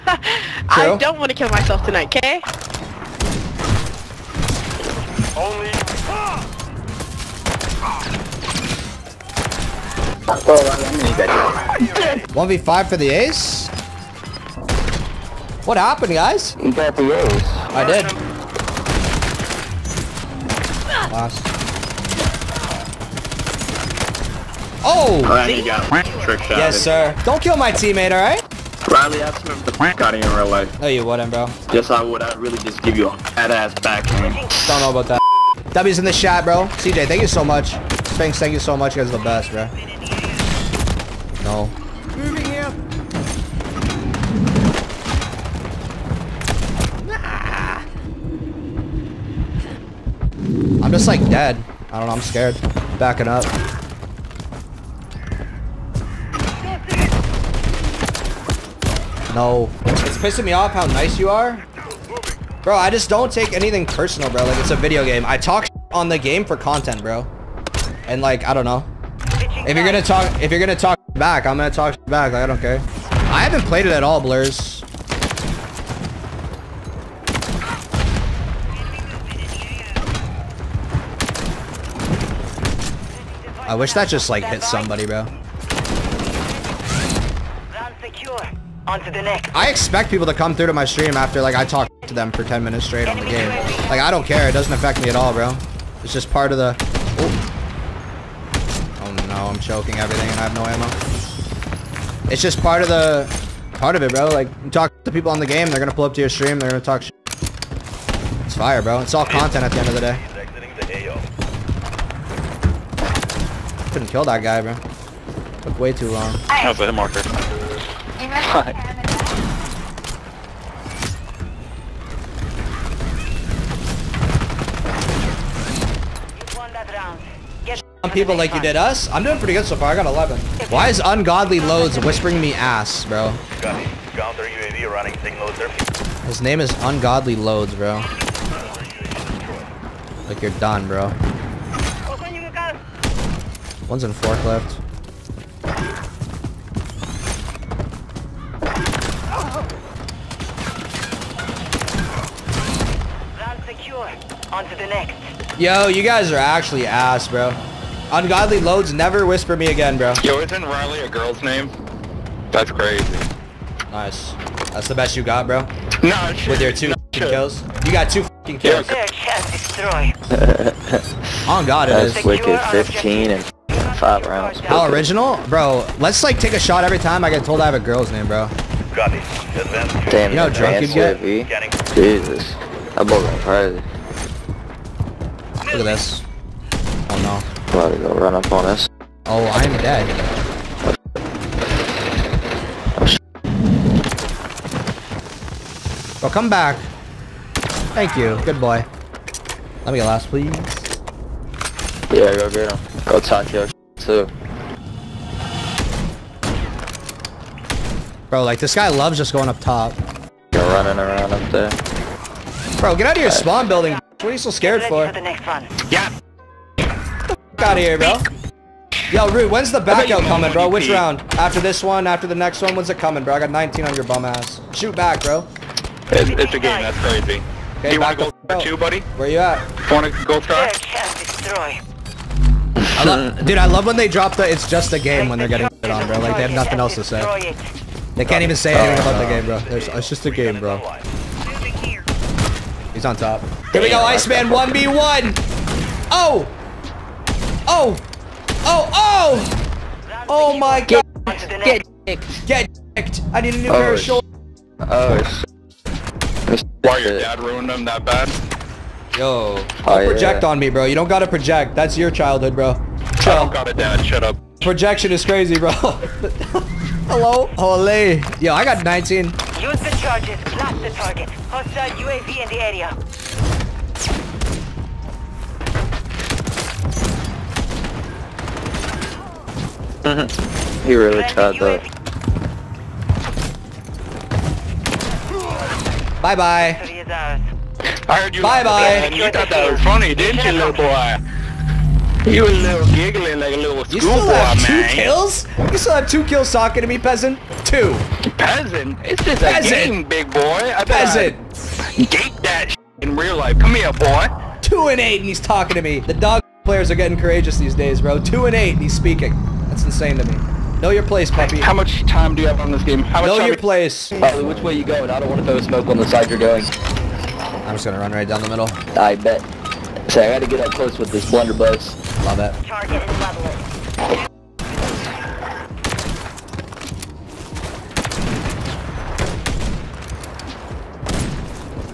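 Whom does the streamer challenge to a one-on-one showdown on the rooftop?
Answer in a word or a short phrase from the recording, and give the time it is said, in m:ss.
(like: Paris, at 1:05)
Iceman, at 4:03.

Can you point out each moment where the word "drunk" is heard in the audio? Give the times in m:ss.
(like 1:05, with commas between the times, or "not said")
3:00.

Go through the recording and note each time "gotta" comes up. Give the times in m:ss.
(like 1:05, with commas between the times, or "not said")
4:21, 5:20.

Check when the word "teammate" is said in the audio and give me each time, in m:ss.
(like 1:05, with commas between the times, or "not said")
0:27.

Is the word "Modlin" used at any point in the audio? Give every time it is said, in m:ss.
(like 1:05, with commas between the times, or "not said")
not said.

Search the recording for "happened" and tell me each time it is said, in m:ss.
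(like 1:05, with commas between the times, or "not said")
0:15.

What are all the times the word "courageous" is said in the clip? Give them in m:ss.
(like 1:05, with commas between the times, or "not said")
5:07.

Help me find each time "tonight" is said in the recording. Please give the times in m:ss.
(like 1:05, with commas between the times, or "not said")
0:01.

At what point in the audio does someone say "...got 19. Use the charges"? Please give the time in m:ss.
4:28.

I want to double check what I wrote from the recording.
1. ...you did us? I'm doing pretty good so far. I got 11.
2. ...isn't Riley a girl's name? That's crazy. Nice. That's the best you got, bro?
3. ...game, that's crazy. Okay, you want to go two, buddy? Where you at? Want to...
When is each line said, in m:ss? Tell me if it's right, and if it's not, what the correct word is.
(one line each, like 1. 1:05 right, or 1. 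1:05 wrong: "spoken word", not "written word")
1. 2:08 right
2. 2:40 right
3. 3:46 right.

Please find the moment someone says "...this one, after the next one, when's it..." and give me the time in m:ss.
3:41.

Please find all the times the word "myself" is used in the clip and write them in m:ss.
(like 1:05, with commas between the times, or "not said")
0:01.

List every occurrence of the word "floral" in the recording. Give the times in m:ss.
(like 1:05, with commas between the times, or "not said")
not said.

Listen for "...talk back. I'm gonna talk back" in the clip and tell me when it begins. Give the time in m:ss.
1:10.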